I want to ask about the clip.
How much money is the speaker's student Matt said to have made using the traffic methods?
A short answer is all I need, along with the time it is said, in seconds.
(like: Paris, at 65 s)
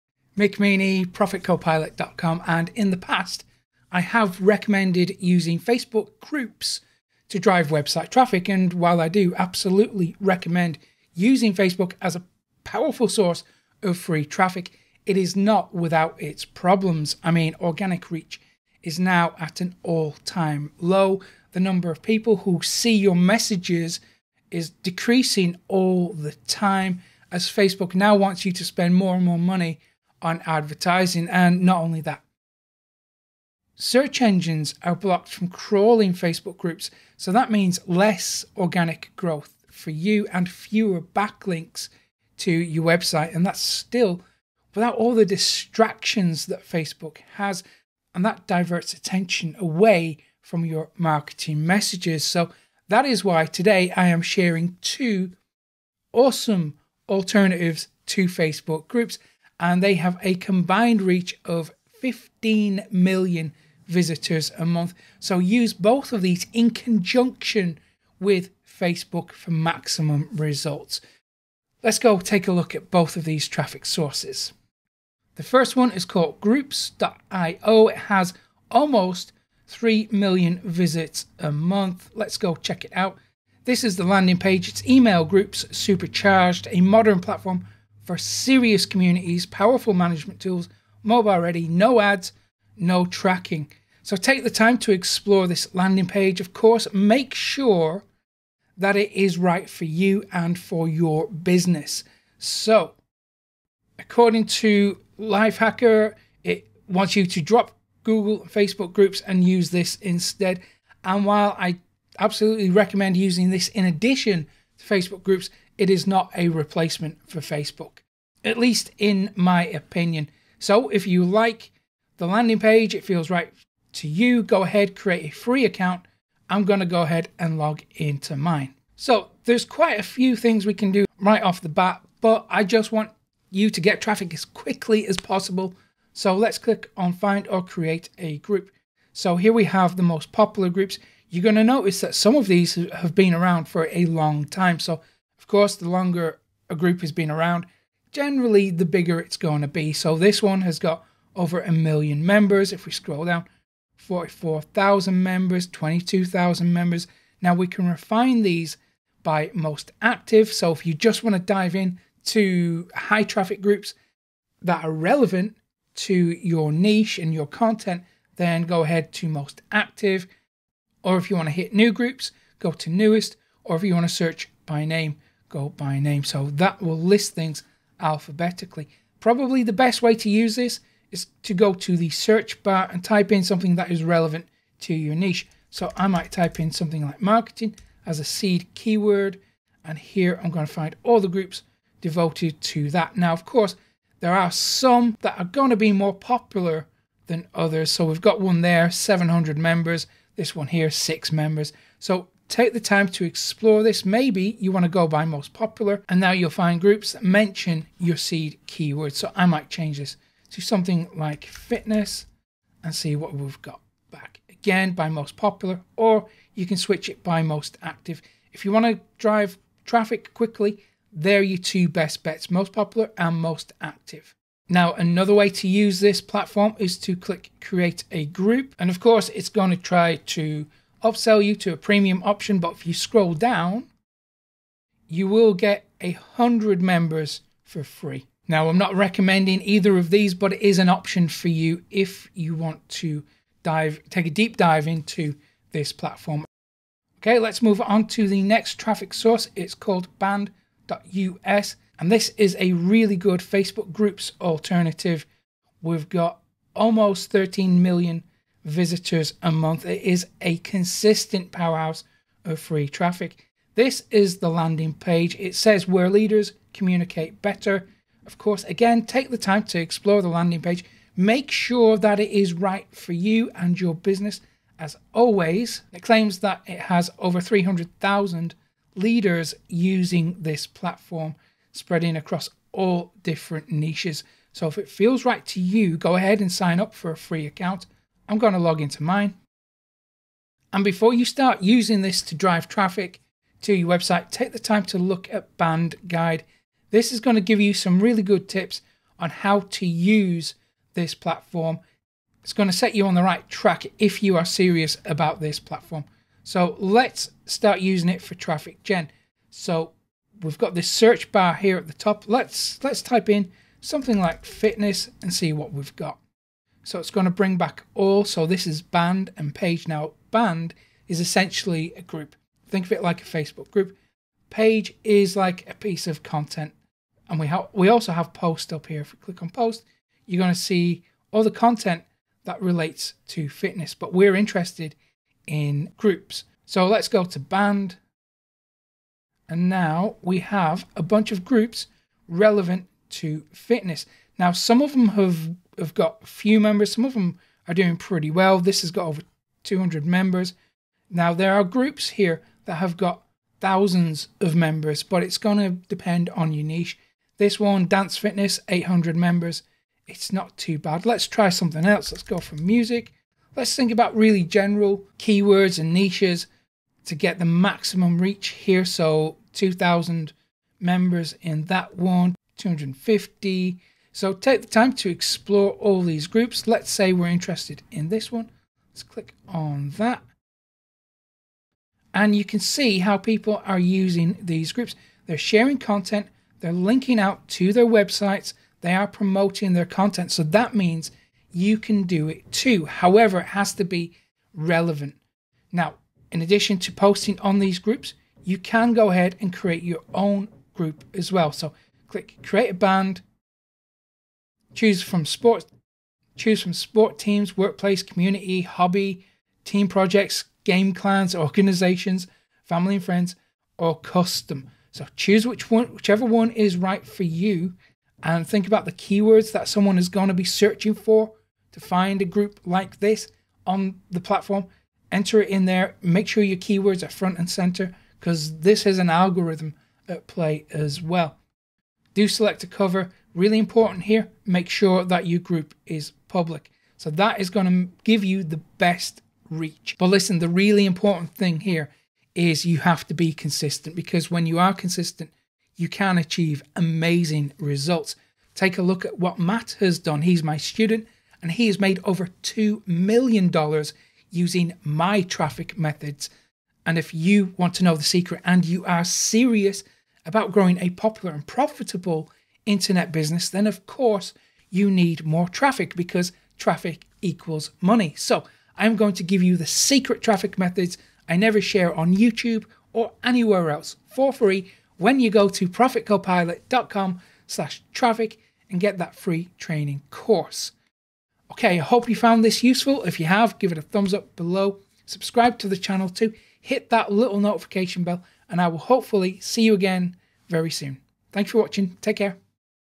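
$2 million, at 452 s.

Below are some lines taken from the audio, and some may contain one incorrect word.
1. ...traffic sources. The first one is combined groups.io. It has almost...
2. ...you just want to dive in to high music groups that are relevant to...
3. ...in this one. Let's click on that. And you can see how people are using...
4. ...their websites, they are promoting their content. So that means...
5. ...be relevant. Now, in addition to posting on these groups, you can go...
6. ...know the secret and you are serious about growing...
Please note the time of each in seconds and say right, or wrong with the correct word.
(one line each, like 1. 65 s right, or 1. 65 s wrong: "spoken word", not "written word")
1. 73 s wrong: "called", not "combined"
2. 160 s wrong: "traffic", not "music"
3. 377 s right
4. 387 s right
5. 393 s right
6. 457 s right.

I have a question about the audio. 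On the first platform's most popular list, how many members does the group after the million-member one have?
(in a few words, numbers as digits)
44,000.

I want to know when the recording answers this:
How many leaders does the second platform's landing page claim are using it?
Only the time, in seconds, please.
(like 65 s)
277 s.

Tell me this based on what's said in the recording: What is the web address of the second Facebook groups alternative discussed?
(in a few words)
band.us.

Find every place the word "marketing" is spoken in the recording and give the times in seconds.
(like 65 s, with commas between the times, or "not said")
50 s, 187 s.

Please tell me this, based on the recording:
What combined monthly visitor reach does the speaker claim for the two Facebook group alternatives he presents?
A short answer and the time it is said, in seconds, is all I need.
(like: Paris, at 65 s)
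15 million, at 62 s.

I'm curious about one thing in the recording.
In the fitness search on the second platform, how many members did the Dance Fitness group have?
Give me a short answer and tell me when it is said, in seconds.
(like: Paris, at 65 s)
800, at 358 s.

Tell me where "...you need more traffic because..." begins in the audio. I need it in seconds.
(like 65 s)
464 s.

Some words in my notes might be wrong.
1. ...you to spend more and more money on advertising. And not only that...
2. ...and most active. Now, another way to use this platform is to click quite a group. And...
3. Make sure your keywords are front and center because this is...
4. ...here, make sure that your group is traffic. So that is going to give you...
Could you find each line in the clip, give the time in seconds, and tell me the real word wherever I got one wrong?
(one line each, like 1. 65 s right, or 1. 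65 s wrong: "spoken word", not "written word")
1. 28 s right
2. 223 s wrong: "create", not "quite"
3. 426 s right
4. 434 s wrong: "public", not "traffic".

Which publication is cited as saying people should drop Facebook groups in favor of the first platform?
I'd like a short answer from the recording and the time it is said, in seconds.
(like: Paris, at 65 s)
Lifehacker, at 105 s.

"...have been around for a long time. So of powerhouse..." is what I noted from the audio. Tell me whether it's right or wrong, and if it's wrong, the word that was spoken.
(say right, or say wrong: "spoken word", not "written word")
wrong: "course", not "powerhouse".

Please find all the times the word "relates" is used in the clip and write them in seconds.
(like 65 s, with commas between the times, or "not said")
332 s.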